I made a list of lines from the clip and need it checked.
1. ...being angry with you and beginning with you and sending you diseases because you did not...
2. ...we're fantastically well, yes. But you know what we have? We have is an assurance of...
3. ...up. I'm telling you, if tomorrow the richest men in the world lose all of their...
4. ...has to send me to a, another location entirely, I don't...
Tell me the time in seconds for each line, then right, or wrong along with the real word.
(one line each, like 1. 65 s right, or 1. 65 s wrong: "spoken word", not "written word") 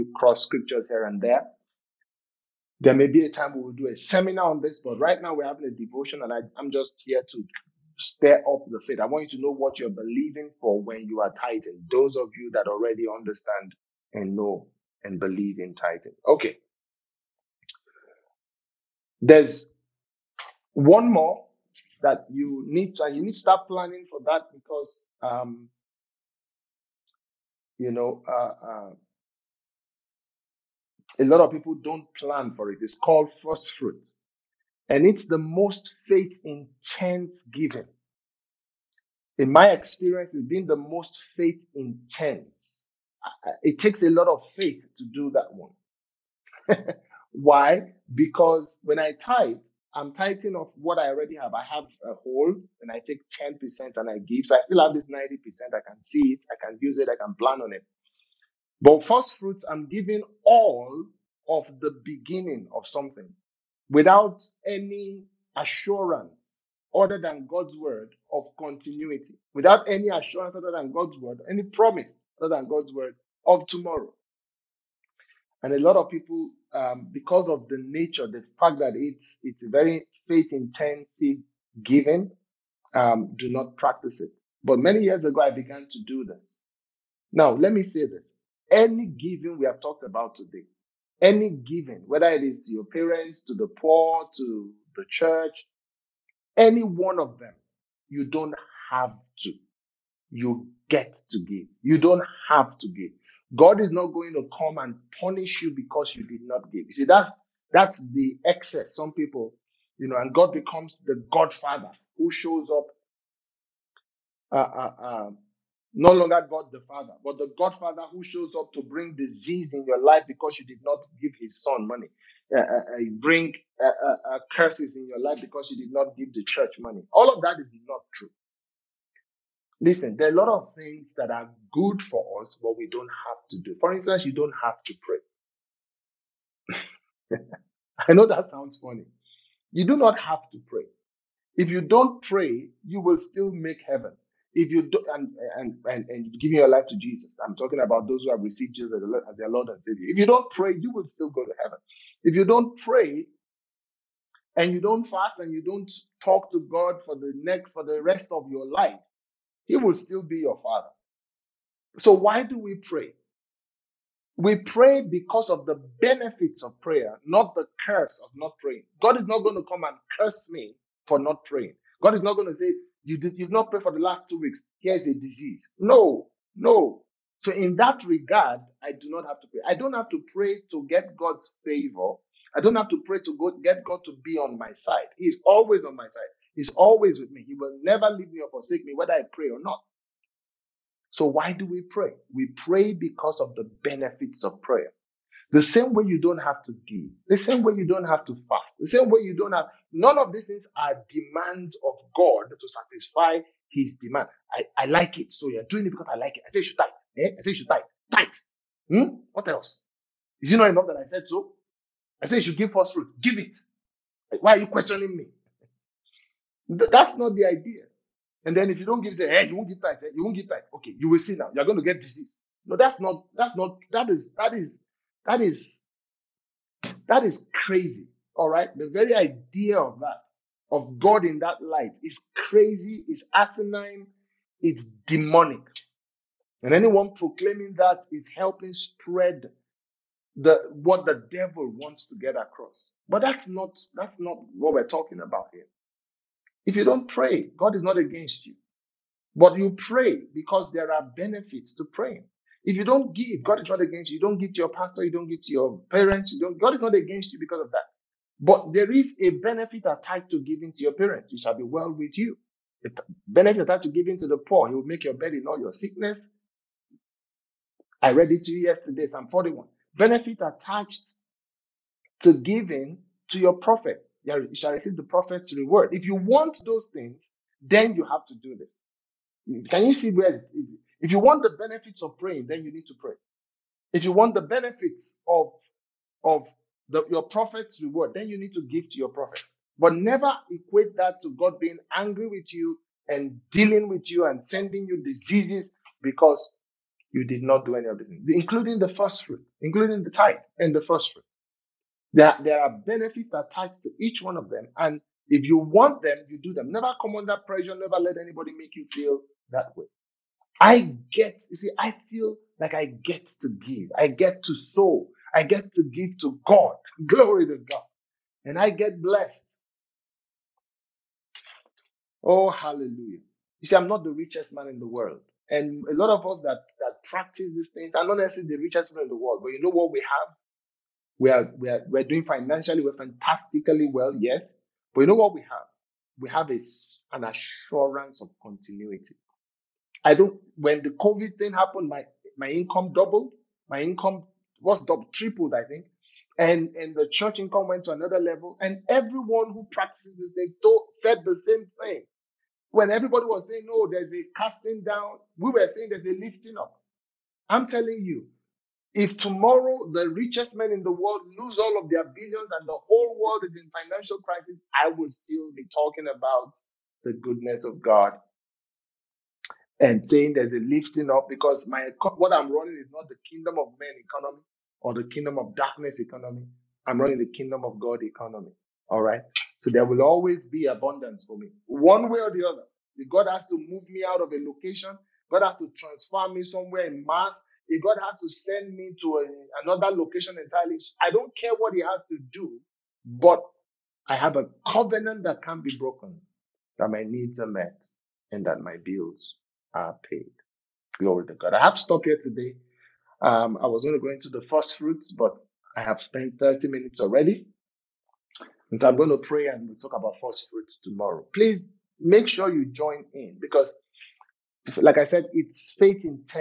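1. 291 s wrong: "dealing", not "beginning"
2. 332 s right
3. 356 s right
4. 388 s right.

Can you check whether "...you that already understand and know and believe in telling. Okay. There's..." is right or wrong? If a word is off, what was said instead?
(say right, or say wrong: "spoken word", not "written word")
wrong: "tithing", not "telling".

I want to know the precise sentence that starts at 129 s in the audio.
Listen, there are a lot of things that are good for us, but we don't have to do.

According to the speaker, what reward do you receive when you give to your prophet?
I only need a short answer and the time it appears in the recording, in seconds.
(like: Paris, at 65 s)
The prophet's reward, at 274 s.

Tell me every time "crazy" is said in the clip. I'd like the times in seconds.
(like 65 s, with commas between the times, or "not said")
227 s, 232 s.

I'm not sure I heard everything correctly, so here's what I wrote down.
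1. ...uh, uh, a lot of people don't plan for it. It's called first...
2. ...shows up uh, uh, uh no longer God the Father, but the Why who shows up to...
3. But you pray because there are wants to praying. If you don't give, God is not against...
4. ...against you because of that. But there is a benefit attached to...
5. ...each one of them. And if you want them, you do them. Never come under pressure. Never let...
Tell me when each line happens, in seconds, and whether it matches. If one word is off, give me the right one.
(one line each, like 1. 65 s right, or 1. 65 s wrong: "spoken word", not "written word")
1. 28 s right
2. 112 s wrong: "Godfather", not "Why"
3. 249 s wrong: "benefits", not "wants"
4. 256 s right
5. 303 s right.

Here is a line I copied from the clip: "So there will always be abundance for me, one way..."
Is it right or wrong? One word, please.
right.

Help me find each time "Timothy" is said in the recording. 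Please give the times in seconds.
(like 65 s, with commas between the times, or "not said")
not said.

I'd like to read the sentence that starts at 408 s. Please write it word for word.
And so I'm going to pray and we'll talk about first fruits tomorrow.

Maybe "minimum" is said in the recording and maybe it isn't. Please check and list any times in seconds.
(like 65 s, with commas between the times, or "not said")
not said.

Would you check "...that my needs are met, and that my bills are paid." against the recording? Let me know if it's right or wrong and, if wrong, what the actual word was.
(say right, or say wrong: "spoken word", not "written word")
right.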